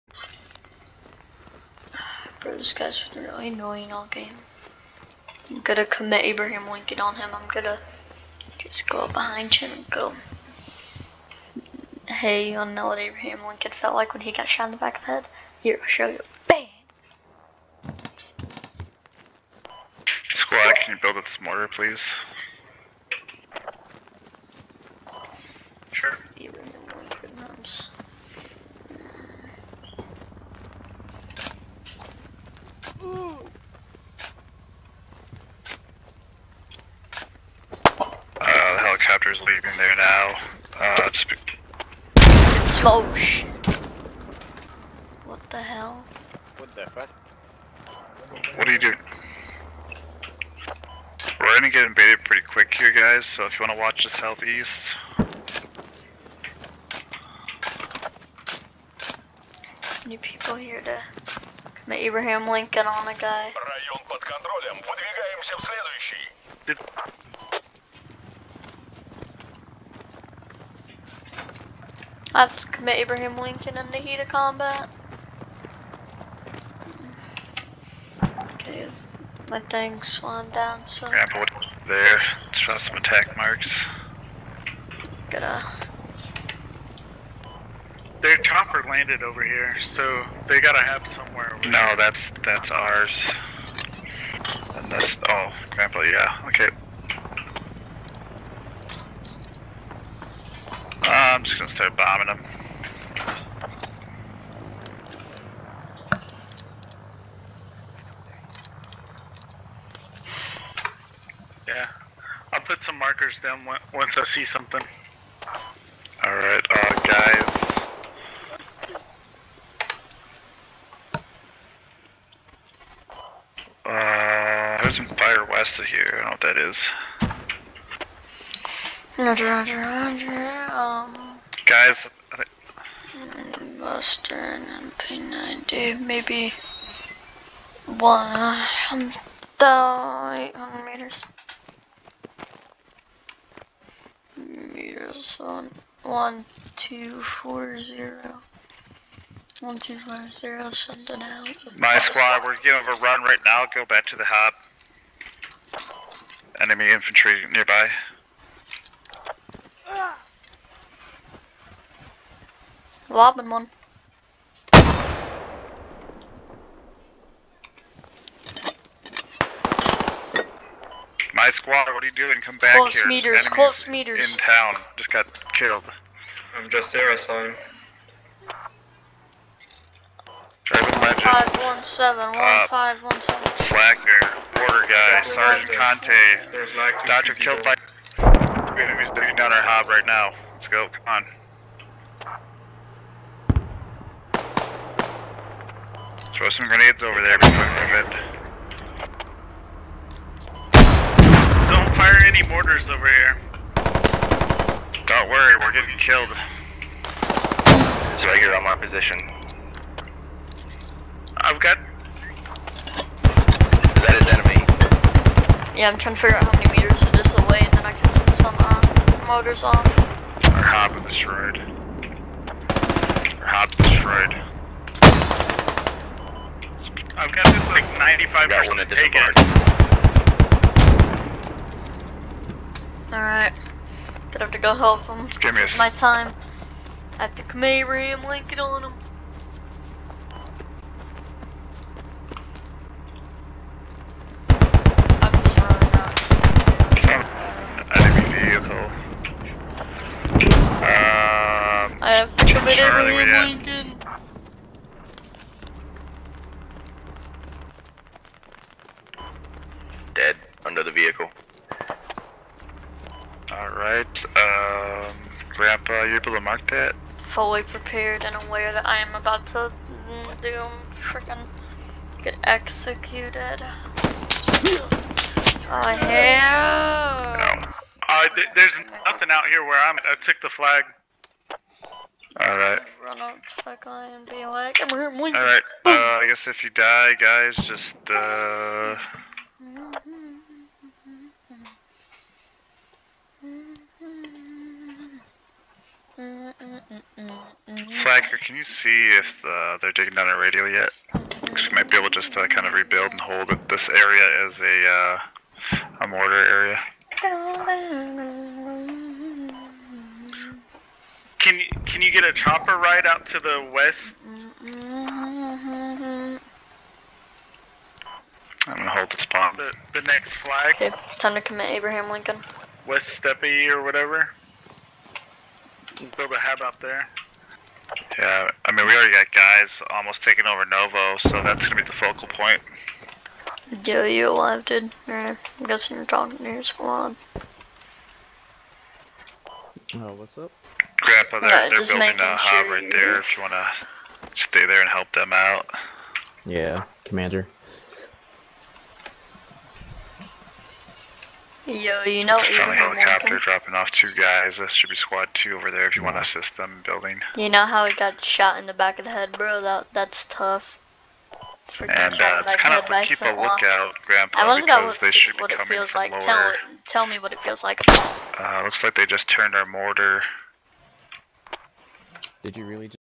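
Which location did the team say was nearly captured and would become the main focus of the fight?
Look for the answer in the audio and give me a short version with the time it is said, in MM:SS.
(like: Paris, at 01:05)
Novo, at 05:30.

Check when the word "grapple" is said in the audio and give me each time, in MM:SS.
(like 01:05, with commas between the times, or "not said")
01:21, 01:35.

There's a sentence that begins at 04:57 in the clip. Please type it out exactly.
Slacker, can you see if uh, they're digging down a radio yet?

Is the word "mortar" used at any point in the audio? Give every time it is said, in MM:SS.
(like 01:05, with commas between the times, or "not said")
03:22, 05:06, 06:09.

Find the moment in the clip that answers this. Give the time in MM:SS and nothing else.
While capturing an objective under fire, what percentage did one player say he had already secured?
03:47.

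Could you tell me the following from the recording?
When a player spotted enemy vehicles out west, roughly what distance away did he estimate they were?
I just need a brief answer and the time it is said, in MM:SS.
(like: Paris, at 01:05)
1800 meters, at 02:17.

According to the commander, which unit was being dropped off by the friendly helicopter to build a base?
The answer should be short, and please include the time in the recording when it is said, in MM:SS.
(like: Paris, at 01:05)
squad two, at 05:54.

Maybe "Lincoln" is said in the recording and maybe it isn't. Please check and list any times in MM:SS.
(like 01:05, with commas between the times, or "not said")
00:06, 00:13, 01:02, 01:13, 05:22.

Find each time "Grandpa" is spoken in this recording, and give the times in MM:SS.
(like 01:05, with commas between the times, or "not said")
04:25, 05:41, 06:04.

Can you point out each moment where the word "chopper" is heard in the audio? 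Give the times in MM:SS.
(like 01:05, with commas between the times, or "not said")
01:28, 05:12.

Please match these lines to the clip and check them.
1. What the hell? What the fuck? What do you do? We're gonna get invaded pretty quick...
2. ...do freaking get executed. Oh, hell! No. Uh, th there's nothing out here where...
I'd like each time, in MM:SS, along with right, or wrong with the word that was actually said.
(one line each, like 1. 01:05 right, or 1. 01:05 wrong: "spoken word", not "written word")
1. 00:45 right
2. 04:30 right.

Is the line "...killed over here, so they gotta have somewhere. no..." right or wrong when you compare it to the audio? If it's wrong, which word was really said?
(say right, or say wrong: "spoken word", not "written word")
wrong: "landed", not "killed".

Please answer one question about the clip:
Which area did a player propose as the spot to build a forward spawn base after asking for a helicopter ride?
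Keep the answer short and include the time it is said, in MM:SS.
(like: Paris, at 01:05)
West Steppe, at 05:22.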